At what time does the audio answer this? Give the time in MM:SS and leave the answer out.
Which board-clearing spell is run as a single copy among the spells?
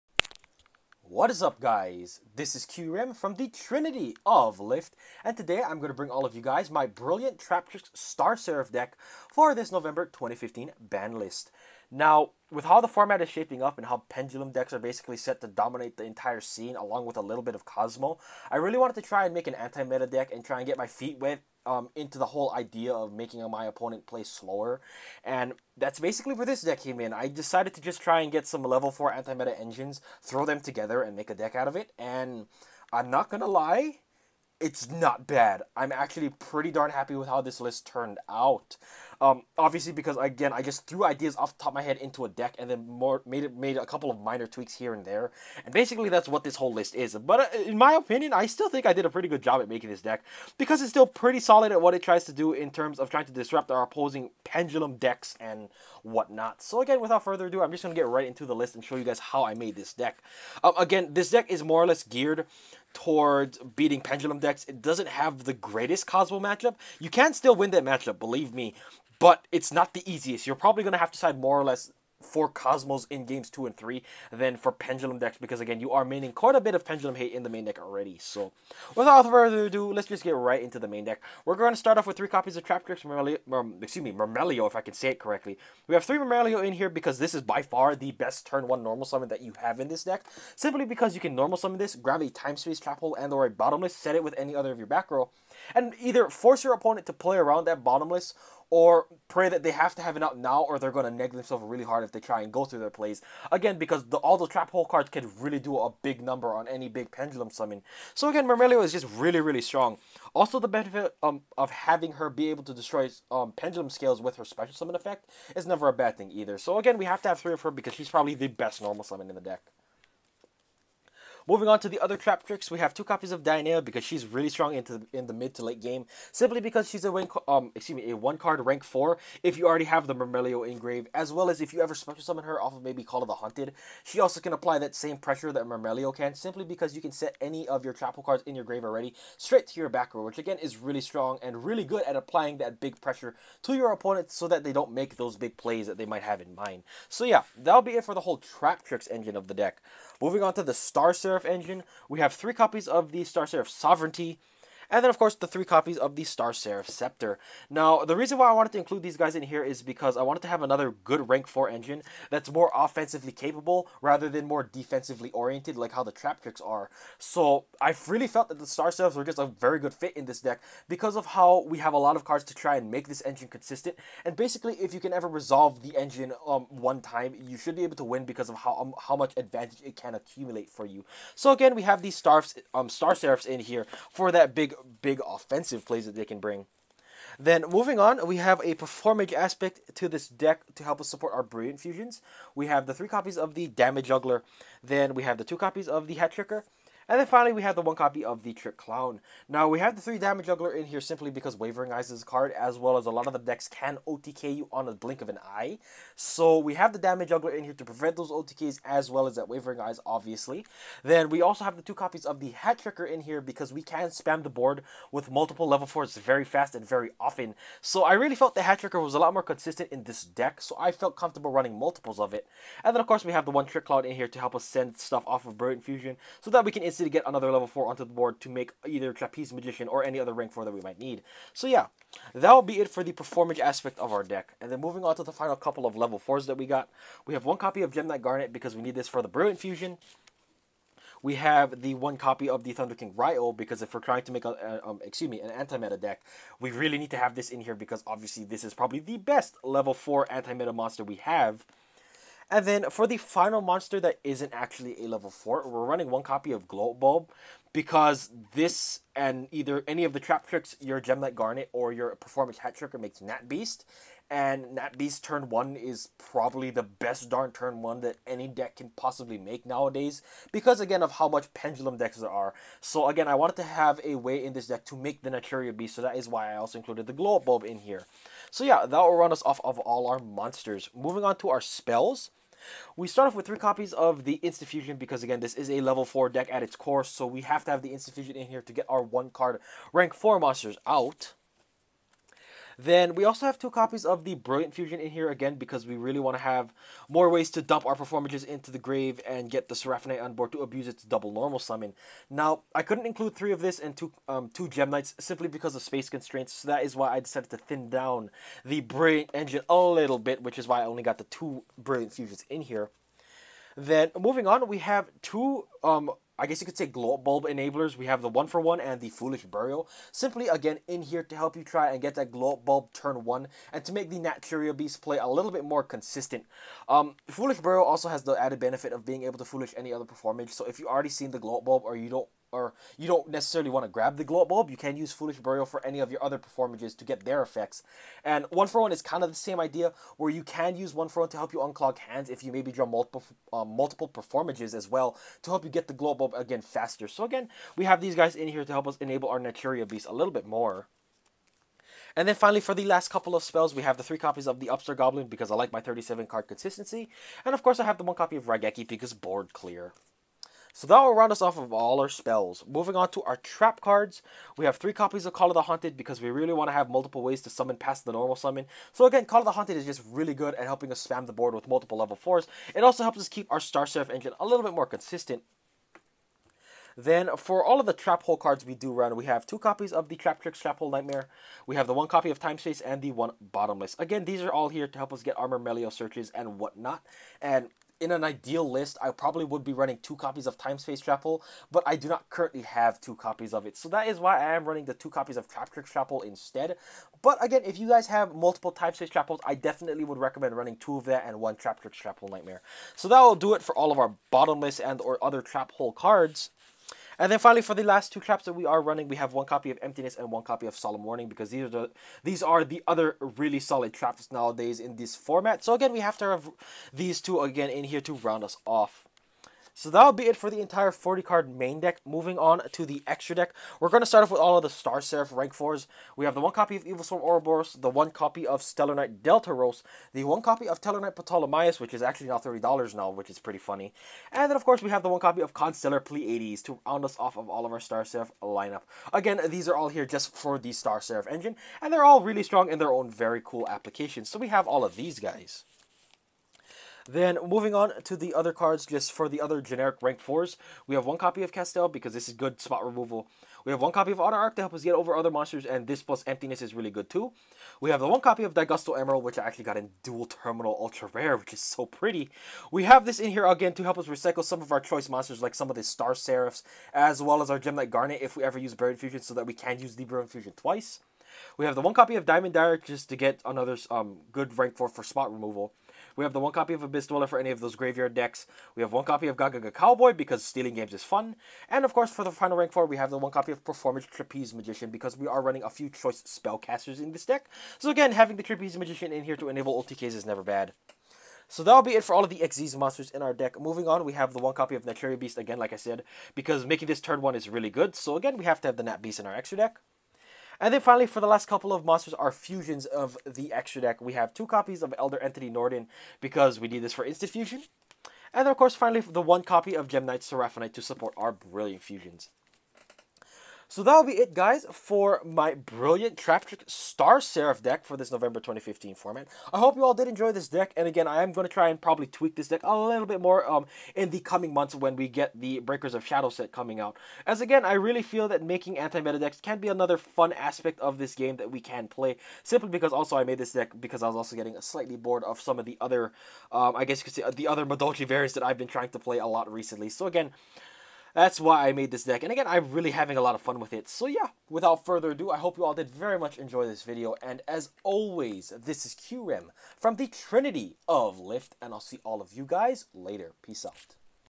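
05:58.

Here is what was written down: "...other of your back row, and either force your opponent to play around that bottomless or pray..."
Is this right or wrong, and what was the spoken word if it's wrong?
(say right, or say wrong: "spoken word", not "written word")
right.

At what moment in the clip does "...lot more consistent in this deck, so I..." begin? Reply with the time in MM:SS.
03:39.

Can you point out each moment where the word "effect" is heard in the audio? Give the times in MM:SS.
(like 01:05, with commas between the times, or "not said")
01:54, 05:37.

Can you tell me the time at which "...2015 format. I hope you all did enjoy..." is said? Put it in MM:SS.
08:38.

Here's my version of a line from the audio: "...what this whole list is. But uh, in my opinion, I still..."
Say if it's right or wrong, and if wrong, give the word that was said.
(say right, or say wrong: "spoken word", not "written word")
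right.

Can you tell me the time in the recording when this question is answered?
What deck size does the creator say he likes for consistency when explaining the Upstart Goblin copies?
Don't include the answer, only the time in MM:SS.
05:55.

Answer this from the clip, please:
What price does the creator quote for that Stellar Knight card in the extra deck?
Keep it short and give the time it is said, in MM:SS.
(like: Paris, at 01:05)
$30, at 07:12.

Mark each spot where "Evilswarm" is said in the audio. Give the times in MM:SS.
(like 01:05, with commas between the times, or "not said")
07:06.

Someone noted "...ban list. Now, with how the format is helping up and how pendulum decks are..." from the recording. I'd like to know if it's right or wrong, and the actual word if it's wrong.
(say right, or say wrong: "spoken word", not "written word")
wrong: "shaping", not "helping".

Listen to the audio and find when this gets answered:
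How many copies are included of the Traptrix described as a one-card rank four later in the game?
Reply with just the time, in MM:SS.
02:02.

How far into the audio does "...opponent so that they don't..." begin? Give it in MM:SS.
02:23.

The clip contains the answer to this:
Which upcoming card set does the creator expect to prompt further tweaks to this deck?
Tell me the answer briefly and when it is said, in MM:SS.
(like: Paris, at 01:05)
Breakers of Shadow, at 08:45.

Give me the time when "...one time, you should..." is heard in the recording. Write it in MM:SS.
02:56.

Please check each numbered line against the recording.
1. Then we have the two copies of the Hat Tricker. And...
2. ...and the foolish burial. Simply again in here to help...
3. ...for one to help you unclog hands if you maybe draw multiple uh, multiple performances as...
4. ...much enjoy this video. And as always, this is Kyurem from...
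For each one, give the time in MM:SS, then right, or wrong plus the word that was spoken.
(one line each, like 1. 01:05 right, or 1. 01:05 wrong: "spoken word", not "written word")
1. 03:14 right
2. 05:18 right
3. 05:41 right
4. 09:06 right.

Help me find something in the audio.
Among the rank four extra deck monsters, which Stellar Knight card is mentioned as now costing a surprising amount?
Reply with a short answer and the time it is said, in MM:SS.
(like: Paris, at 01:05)
Stellar Knight Ptolemaeus, at 07:10.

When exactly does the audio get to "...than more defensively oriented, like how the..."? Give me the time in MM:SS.
02:44.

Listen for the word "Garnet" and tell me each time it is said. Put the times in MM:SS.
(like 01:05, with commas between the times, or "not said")
03:58, 04:21, 07:47.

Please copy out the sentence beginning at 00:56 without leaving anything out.
So again, without further ado, I'm just gonna get right into the list and show you guys how I made this deck.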